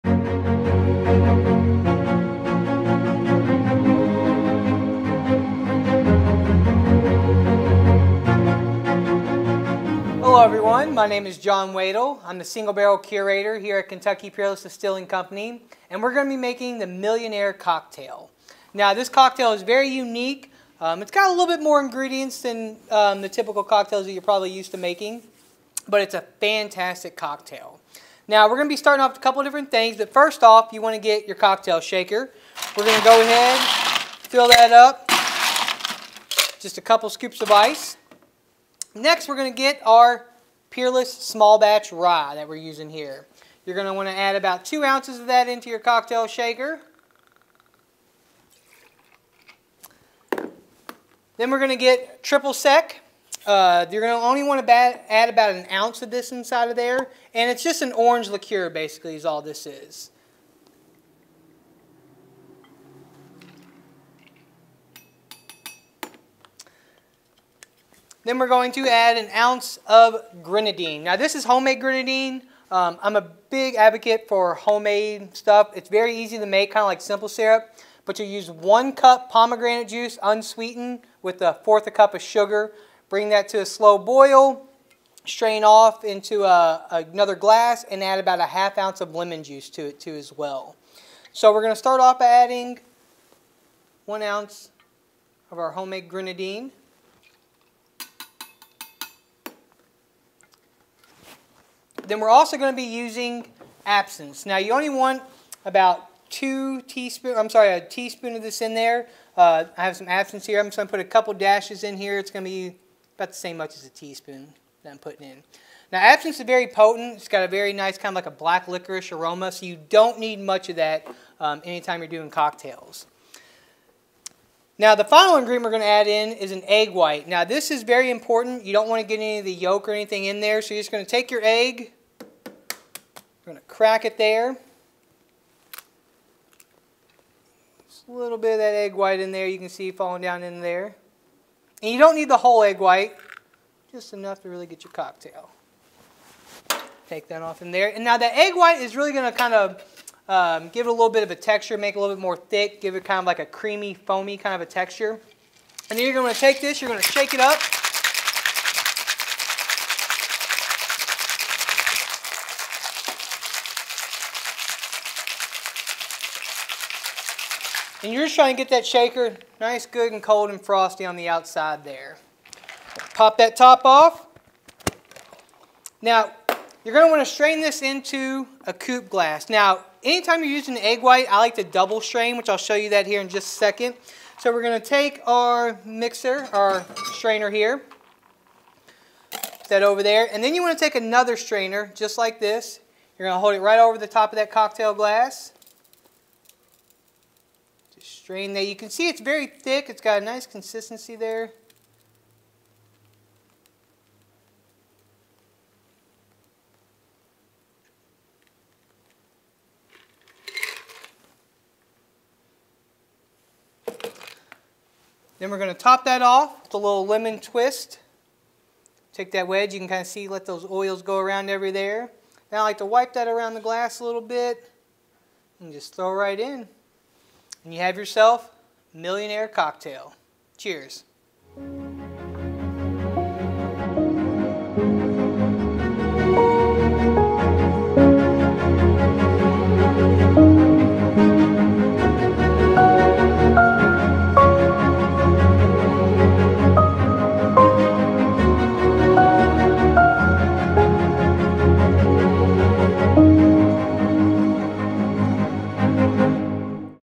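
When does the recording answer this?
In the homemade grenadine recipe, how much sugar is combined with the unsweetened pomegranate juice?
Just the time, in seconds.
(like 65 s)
81 s.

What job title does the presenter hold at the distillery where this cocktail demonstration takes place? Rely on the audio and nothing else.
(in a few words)
Single barrel curator.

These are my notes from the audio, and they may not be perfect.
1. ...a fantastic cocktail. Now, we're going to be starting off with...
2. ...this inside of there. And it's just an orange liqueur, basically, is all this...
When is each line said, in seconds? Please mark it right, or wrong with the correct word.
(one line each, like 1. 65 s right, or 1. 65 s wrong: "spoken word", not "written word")
1. 26 s right
2. 56 s right.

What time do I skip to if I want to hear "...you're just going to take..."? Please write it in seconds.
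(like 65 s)
130 s.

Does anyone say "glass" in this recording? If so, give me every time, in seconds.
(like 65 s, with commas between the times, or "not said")
87 s, 179 s, 194 s, 223 s.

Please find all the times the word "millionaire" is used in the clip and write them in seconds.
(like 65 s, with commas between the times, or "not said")
16 s, 228 s.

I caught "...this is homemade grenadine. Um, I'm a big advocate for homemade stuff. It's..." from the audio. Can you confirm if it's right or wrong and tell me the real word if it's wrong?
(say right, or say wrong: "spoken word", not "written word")
right.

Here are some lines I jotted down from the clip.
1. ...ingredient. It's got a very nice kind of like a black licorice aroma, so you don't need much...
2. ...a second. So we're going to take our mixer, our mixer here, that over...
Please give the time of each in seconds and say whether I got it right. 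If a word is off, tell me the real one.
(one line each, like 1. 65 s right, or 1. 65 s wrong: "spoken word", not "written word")
1. 116 s wrong: "potent", not "ingredient"
2. 183 s wrong: "strainer", not "mixer".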